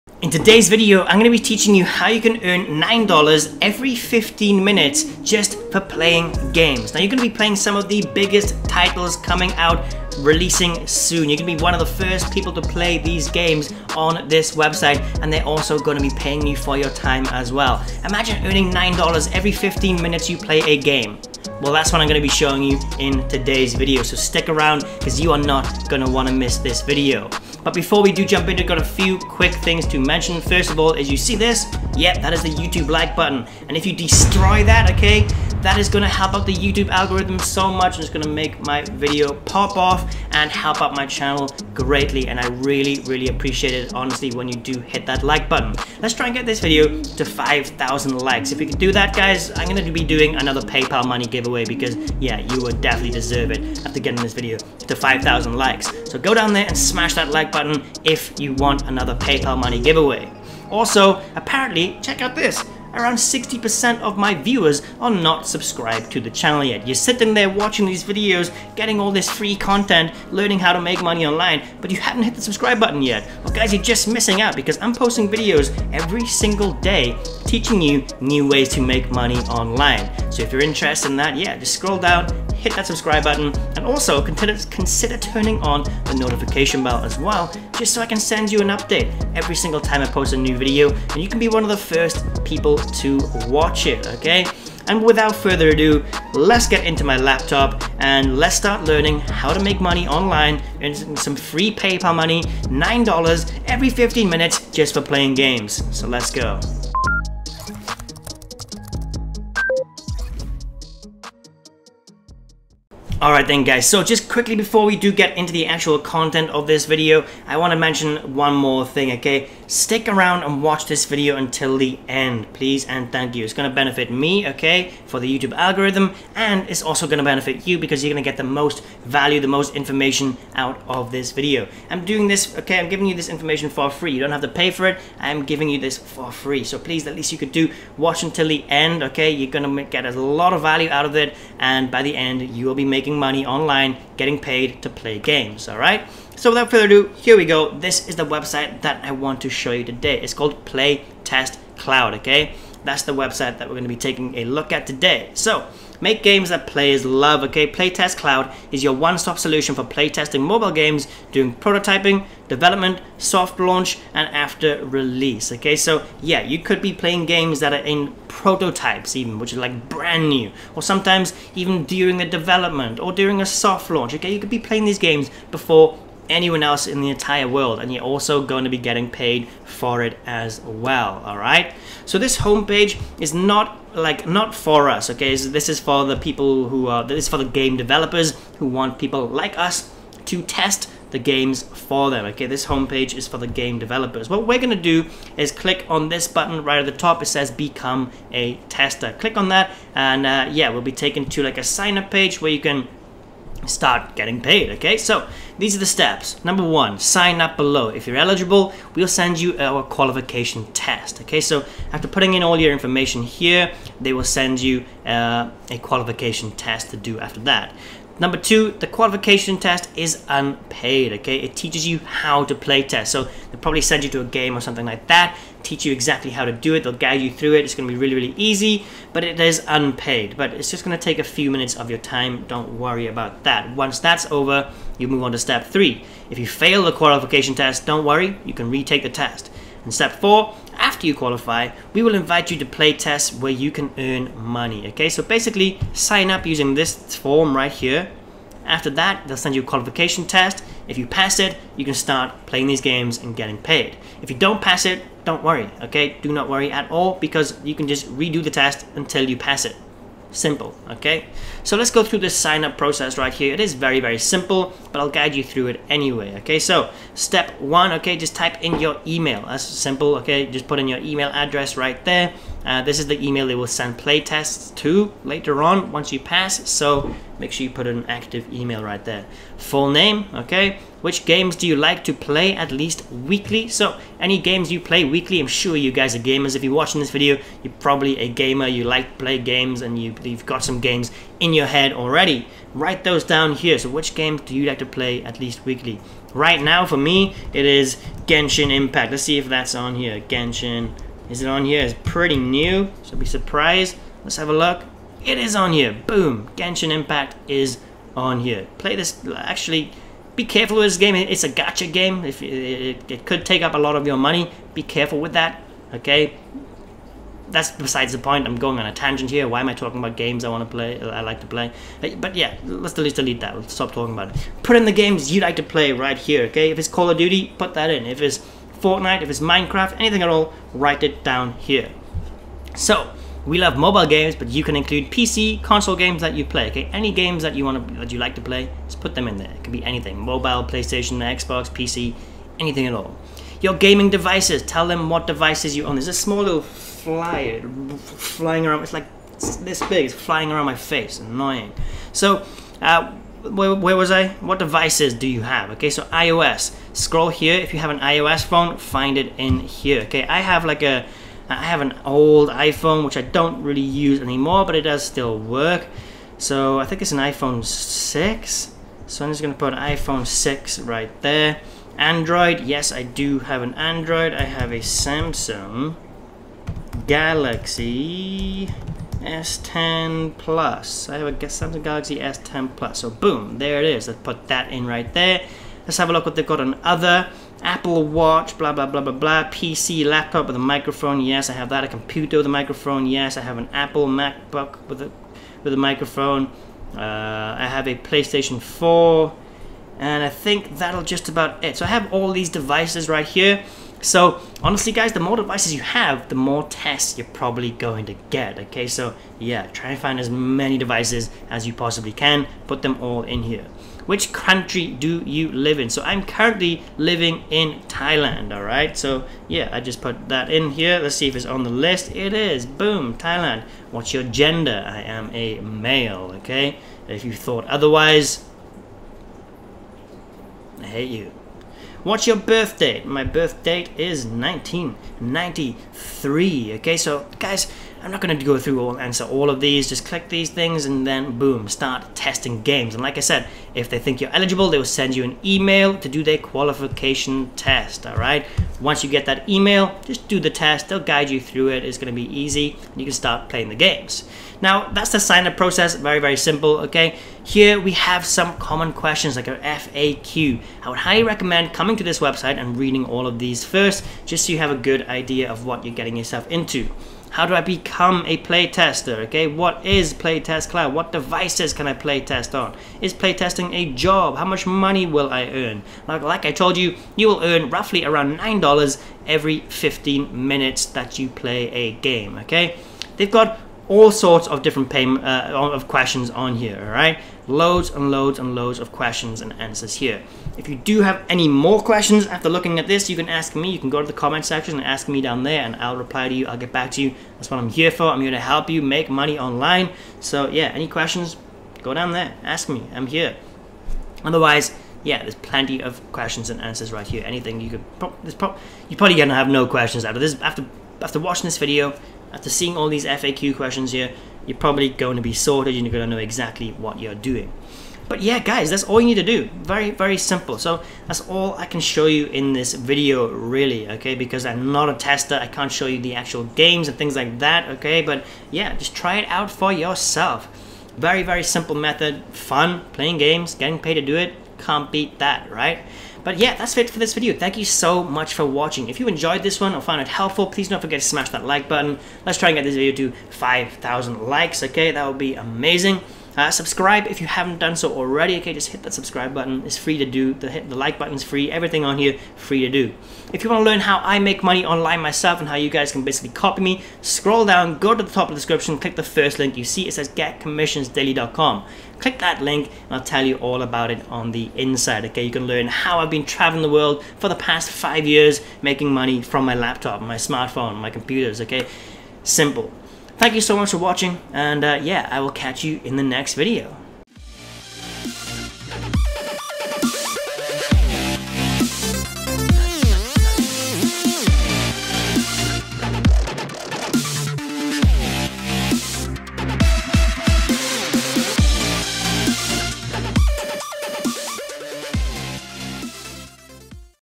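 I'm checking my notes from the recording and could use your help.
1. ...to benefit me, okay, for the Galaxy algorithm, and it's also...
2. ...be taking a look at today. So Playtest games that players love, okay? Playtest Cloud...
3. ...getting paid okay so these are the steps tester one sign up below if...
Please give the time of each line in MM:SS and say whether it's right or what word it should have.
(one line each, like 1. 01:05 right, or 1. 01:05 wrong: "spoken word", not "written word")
1. 02:03 wrong: "YouTube", not "Galaxy"
2. 02:33 wrong: "Make", not "Playtest"
3. 03:24 wrong: "number", not "tester".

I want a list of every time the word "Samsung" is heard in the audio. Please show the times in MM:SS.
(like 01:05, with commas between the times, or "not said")
06:14, 06:21.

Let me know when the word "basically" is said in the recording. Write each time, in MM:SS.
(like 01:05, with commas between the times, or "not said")
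04:05, 09:16.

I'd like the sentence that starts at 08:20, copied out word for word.
So, yeah, any questions, go down there.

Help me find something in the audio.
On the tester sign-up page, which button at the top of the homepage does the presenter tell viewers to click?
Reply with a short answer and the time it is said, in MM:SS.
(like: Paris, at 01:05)
Become a tester, at 03:17.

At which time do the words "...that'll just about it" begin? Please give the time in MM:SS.
06:40.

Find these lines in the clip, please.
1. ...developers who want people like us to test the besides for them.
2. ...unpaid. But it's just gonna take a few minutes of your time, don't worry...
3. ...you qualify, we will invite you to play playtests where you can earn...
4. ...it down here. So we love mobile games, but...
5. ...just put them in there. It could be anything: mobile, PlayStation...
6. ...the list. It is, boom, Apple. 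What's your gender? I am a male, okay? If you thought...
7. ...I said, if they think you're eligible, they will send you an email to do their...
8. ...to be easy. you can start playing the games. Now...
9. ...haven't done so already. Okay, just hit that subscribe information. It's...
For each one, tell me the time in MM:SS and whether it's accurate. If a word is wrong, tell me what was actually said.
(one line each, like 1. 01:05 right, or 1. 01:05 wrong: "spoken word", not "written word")
1. 03:07 wrong: "games", not "besides"
2. 03:49 right
3. 04:01 wrong: "tests", not "playtests"
4. 05:31 right
5. 05:38 right
6. 07:01 wrong: "Thailand", not "Apple"
7. 07:23 right
8. 07:32 right
9. 09:07 wrong: "button", not "information".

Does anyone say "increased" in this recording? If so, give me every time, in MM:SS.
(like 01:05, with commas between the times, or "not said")
not said.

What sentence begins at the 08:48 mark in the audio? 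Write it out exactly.
But yeah, just try it out for yourself.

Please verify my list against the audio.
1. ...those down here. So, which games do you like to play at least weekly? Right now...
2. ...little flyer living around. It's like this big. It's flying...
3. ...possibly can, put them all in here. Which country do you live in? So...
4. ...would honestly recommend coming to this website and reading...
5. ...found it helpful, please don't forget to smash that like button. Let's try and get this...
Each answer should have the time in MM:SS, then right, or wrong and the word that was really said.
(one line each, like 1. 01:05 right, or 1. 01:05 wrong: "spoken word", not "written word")
1. 04:53 right
2. 05:46 wrong: "flying", not "living"
3. 06:51 right
4. 07:40 wrong: "highly", not "honestly"
5. 08:59 right.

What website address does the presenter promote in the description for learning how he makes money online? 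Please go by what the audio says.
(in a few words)
getcommissionsdaily.com.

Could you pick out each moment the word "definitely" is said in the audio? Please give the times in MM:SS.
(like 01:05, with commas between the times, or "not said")
00:52.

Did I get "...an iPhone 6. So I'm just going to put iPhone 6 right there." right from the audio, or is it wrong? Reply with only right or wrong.
right.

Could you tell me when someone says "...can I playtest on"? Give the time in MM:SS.
07:51.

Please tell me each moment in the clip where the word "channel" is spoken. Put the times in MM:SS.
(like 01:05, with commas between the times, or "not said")
00:41, 01:06.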